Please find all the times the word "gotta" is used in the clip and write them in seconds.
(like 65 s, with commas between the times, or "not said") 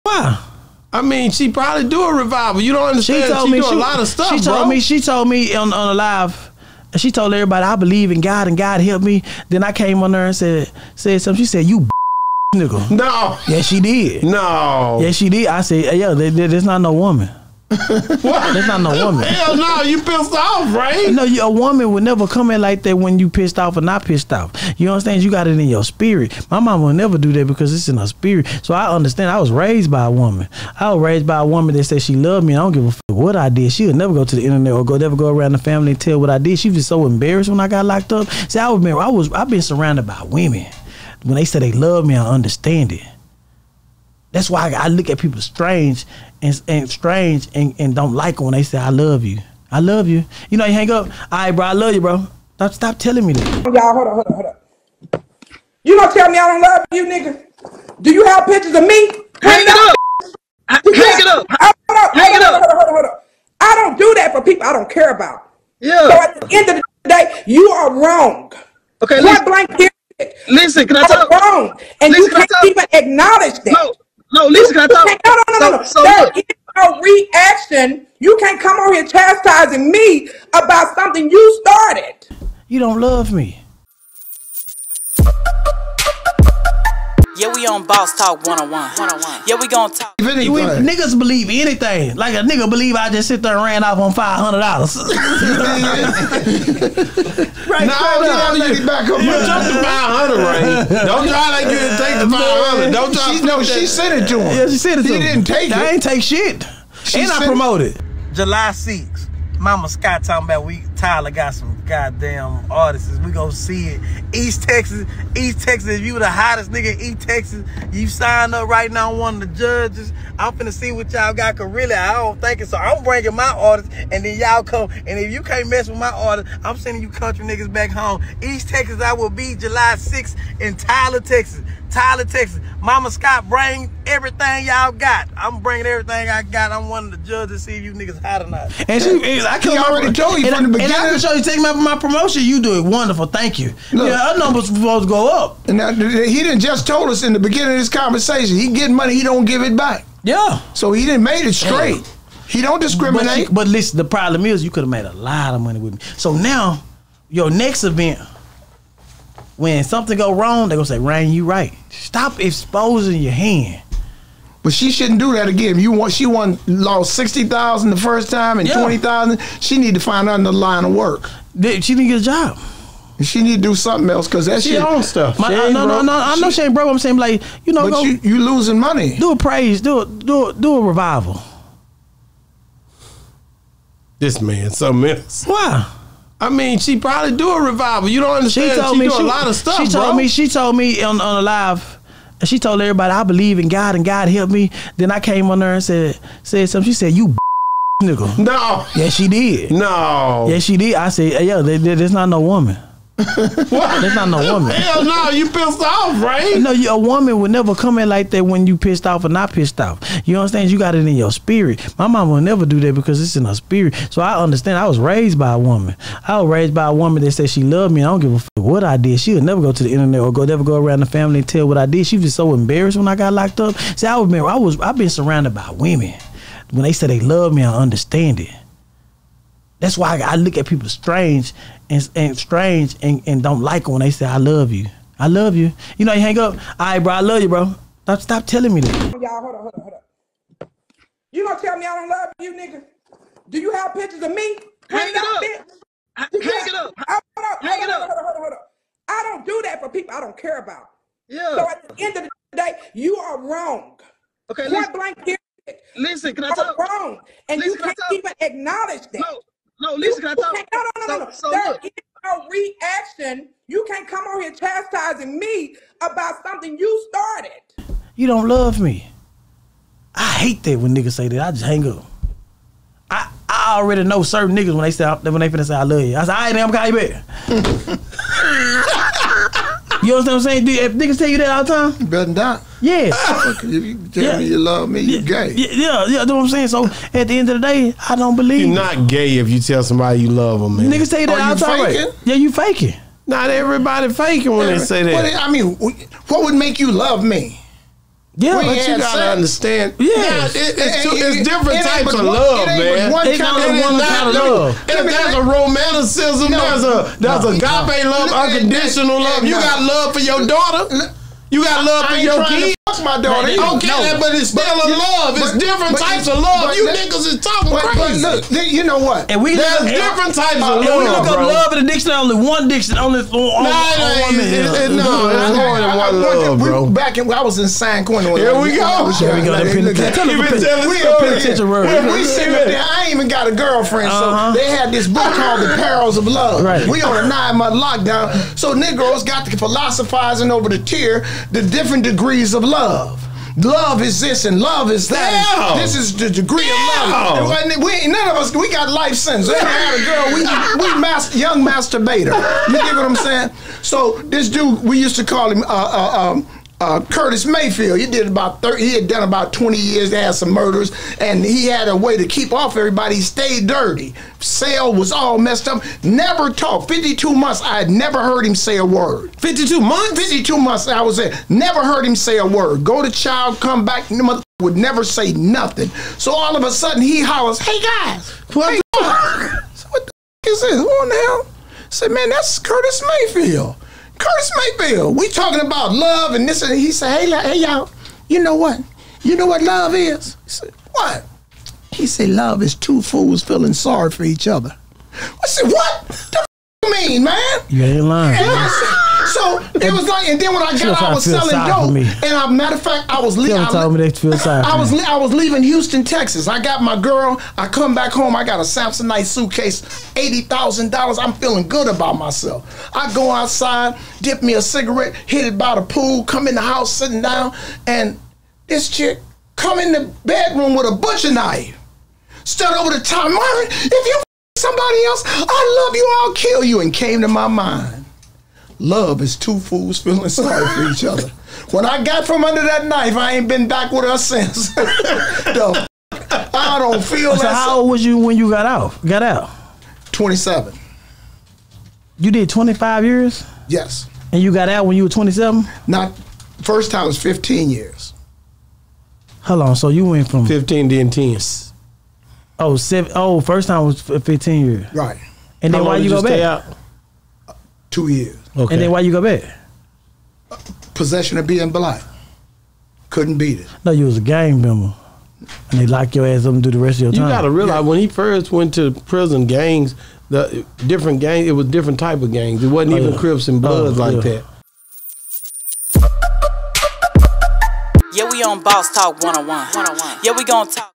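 298 s, 467 s.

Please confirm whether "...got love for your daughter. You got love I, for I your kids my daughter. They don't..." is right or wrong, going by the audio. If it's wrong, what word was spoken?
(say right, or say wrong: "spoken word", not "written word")
right.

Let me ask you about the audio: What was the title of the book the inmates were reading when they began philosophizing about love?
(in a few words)
The Perils of Love.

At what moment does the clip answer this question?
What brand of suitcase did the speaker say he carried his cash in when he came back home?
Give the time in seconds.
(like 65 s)
408 s.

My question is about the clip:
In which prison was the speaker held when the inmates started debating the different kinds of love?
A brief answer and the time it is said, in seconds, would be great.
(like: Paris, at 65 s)
San Quentin, at 327 s.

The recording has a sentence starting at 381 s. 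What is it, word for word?
I said, man, that's Curtis Mayfield.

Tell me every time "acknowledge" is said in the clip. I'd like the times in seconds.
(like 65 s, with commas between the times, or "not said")
72 s, 258 s.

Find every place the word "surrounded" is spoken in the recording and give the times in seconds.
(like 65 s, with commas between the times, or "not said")
39 s, 225 s.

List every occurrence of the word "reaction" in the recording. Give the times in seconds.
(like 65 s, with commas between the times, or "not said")
77 s.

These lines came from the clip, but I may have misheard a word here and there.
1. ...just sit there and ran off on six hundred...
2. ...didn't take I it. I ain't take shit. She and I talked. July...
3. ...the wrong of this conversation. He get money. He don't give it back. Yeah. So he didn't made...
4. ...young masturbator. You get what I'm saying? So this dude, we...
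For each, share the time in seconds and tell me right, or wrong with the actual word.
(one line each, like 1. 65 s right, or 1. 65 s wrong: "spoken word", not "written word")
1. 93 s wrong: "five", not "six"
2. 105 s wrong: "promoted", not "talked"
3. 147 s wrong: "beginning", not "wrong"
4. 351 s right.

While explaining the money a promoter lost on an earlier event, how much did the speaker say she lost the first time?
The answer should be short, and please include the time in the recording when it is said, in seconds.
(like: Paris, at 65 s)
60,000, at 167 s.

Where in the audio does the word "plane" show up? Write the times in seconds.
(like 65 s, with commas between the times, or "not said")
not said.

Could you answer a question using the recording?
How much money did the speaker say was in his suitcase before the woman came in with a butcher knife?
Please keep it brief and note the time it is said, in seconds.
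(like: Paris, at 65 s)
$80,000, at 410 s.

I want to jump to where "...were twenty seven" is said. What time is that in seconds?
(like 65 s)
445 s.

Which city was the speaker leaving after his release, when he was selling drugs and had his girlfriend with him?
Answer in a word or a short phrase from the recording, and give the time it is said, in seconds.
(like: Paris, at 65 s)
Houston, at 405 s.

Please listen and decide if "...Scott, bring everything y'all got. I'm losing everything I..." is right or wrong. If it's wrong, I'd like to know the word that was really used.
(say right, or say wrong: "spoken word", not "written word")
wrong: "bringing", not "losing".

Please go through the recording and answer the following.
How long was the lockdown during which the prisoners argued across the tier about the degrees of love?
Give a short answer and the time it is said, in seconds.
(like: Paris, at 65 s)
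9 months, at 337 s.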